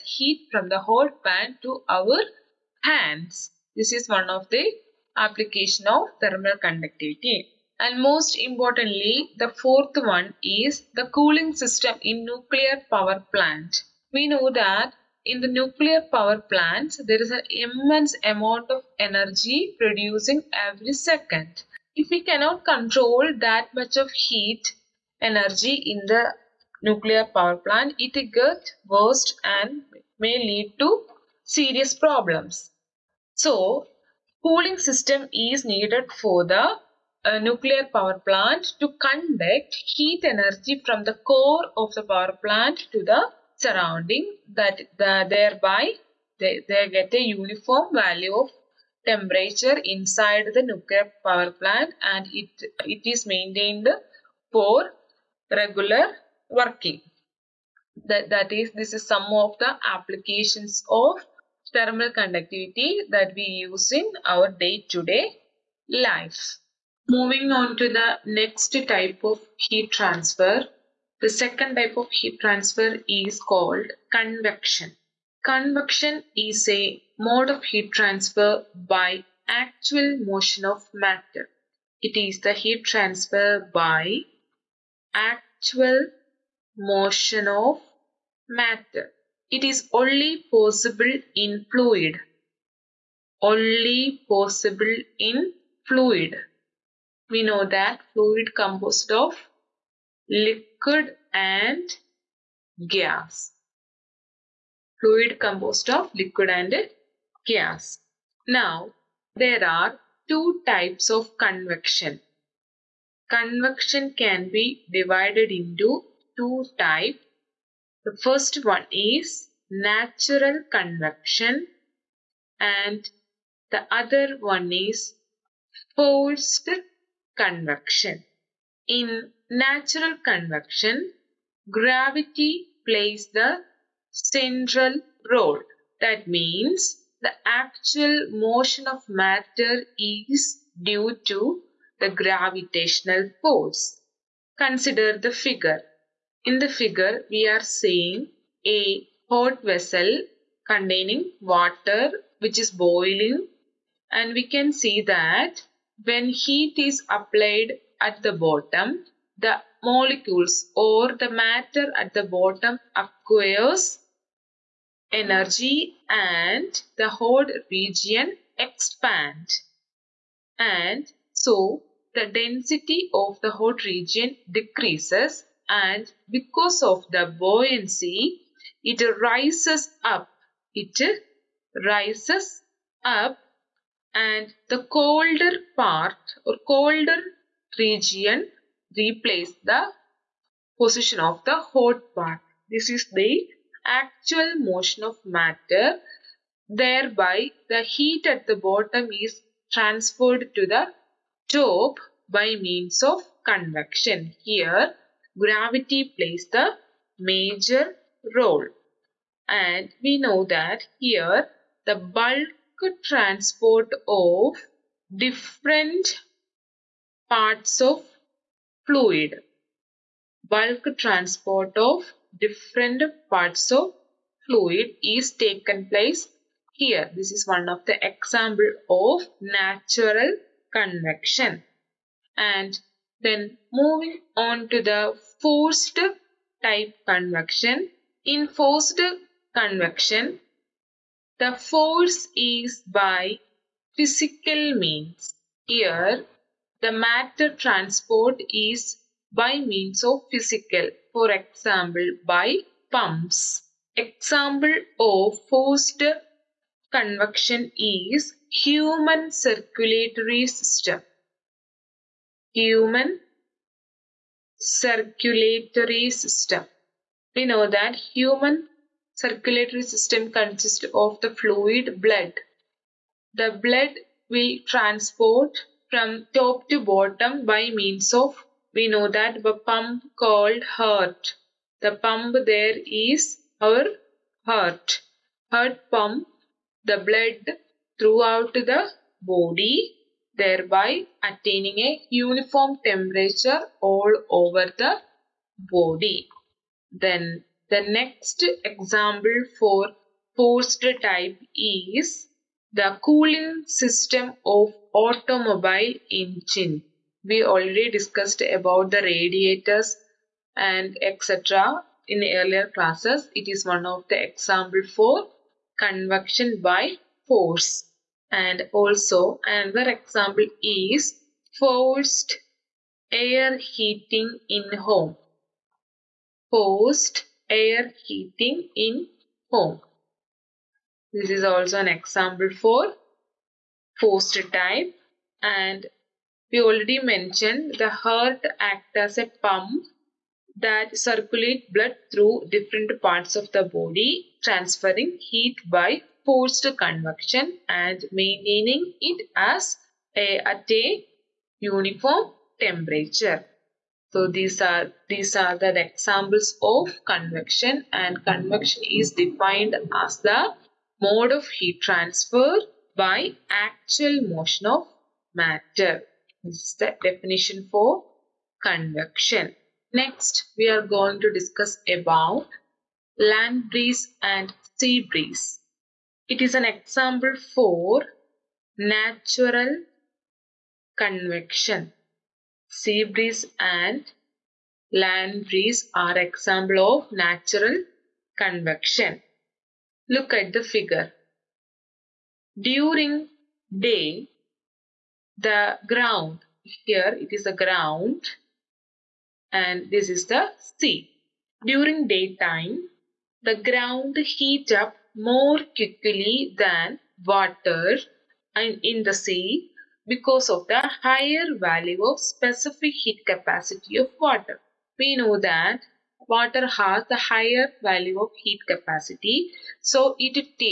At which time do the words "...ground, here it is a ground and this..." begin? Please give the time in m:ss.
6:35.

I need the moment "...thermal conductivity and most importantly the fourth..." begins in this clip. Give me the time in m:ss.
0:06.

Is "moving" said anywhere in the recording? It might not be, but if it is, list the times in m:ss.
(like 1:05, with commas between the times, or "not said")
1:07, 3:53.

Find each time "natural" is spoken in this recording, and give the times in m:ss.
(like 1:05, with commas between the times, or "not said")
1:59, 2:09, 3:49, 6:18, 6:27.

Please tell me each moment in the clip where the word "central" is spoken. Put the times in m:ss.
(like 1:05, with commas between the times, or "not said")
2:14.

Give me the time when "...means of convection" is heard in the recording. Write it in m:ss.
3:22.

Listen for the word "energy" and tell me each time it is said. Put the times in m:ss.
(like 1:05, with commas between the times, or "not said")
0:19, 0:25, 0:40, 2:45.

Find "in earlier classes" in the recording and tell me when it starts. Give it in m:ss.
5:12.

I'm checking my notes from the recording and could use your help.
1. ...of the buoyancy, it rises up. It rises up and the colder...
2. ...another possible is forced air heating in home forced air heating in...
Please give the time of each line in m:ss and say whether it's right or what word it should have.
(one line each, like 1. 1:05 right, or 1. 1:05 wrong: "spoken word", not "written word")
1. 2:56 right
2. 5:19 wrong: "example", not "possible".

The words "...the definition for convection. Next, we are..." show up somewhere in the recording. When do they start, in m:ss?
6:06.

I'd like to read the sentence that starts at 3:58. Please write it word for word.
In forced convection, the force is by physical means.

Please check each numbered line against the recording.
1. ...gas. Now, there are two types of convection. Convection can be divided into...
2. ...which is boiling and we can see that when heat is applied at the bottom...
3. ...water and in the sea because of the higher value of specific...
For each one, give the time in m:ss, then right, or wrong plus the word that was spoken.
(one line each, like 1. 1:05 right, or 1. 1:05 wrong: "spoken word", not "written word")
1. 1:47 right
2. 2:32 right
3. 6:47 right.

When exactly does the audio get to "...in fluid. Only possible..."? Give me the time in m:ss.
1:31.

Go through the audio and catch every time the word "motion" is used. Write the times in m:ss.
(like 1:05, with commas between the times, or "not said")
1:20, 1:26, 2:18, 3:14, 6:04.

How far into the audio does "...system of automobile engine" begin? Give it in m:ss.
5:03.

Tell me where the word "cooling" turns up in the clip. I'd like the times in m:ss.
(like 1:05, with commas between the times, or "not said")
0:11, 0:34, 5:03.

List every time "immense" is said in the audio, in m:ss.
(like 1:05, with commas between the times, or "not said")
0:17.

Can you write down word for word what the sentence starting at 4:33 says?
The blood we transport from top to bottom by means of, we know that the pump called heart.